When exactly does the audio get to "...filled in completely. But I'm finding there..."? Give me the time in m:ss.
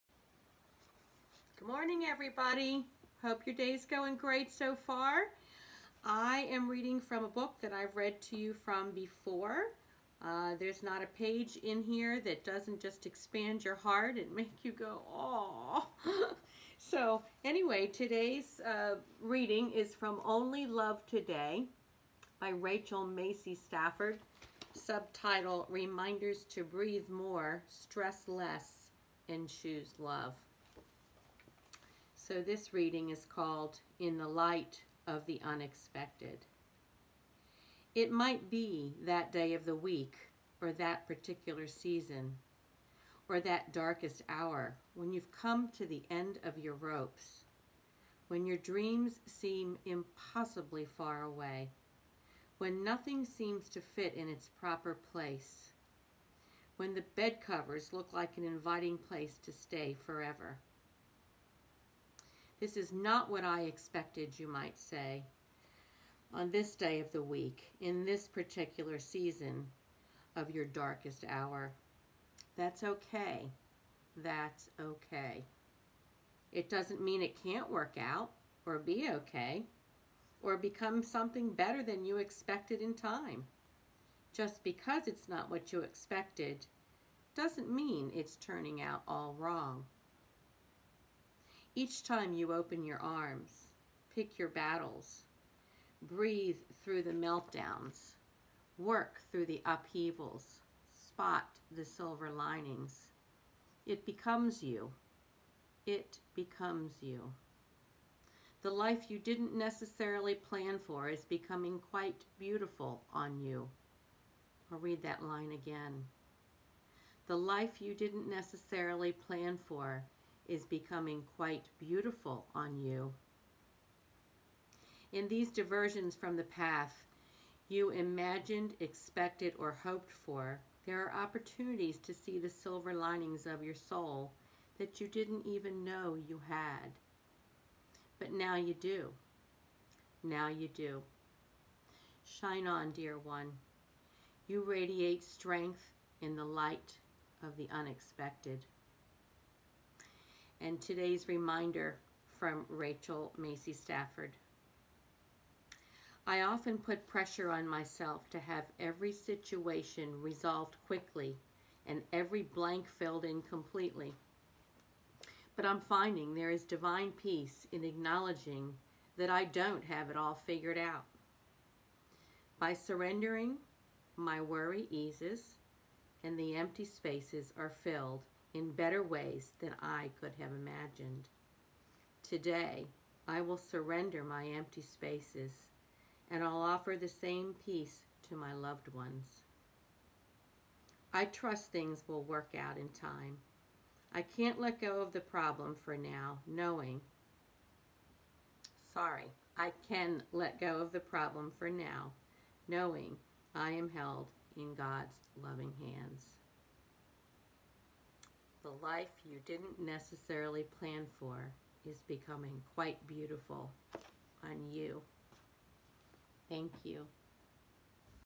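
2:42.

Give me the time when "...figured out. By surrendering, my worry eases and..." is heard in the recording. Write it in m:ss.
2:50.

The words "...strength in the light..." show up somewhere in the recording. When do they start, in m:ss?
2:25.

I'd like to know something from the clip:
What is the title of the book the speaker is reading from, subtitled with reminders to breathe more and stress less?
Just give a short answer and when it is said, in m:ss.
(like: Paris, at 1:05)
Only Love Today, at 0:20.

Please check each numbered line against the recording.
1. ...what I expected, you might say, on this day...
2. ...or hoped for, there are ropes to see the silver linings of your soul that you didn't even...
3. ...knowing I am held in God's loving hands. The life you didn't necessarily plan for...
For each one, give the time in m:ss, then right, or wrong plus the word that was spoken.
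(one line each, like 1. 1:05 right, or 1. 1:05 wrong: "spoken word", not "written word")
1. 1:03 right
2. 2:09 wrong: "opportunities", not "ropes"
3. 3:22 right.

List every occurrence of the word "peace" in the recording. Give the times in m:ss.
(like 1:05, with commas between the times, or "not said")
2:47, 3:07.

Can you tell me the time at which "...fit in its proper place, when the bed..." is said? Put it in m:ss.
0:53.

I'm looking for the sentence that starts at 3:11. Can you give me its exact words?
I trust things will work out in time.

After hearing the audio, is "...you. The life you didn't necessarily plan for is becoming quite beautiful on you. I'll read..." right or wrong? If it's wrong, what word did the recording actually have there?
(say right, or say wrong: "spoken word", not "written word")
right.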